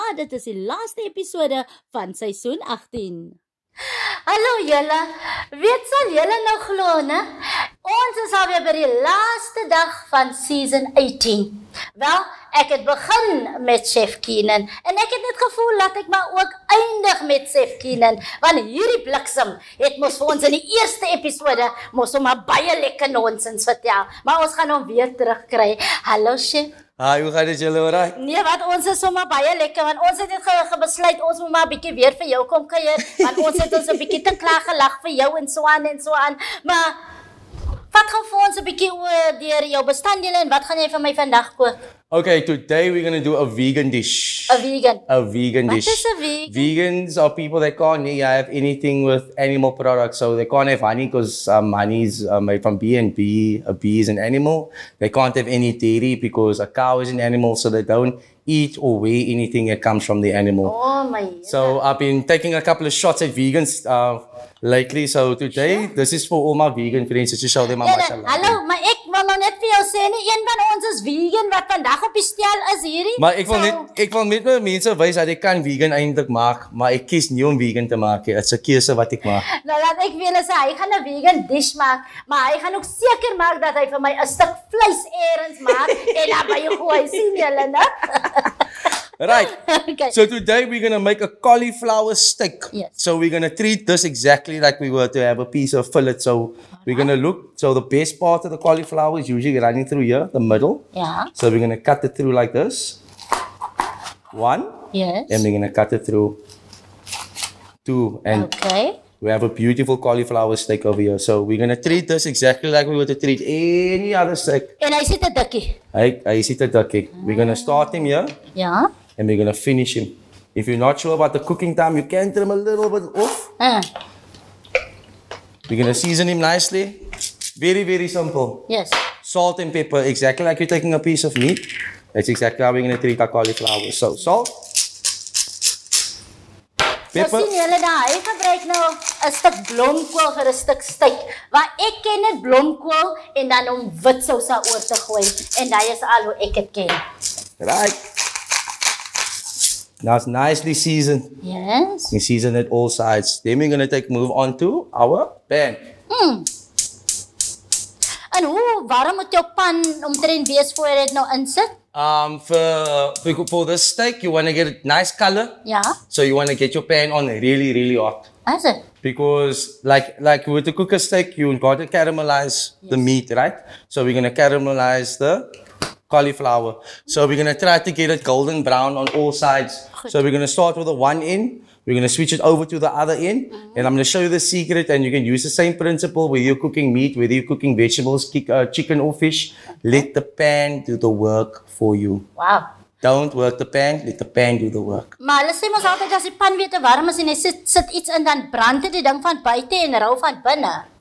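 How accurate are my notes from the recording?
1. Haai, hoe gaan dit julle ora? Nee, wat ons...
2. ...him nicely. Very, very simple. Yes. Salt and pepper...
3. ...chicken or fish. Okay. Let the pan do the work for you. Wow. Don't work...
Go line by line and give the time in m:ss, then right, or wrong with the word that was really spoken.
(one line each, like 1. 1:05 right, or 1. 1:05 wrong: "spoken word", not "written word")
1. 0:26 right
2. 2:06 right
3. 3:08 right.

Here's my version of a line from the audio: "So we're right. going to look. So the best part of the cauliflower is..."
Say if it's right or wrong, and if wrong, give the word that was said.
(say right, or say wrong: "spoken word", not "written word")
right.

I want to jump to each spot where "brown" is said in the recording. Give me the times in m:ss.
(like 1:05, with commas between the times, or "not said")
2:58.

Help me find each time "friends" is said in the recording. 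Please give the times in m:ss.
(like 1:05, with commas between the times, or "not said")
1:07.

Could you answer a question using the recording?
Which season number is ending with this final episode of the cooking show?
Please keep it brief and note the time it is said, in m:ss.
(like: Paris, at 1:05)
18, at 0:02.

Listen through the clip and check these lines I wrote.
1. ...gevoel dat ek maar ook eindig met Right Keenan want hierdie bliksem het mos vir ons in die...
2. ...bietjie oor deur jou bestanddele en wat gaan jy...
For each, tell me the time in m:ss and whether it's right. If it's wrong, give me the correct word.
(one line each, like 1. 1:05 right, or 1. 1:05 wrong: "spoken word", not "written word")
1. 0:15 wrong: "Chef", not "Right"
2. 0:38 right.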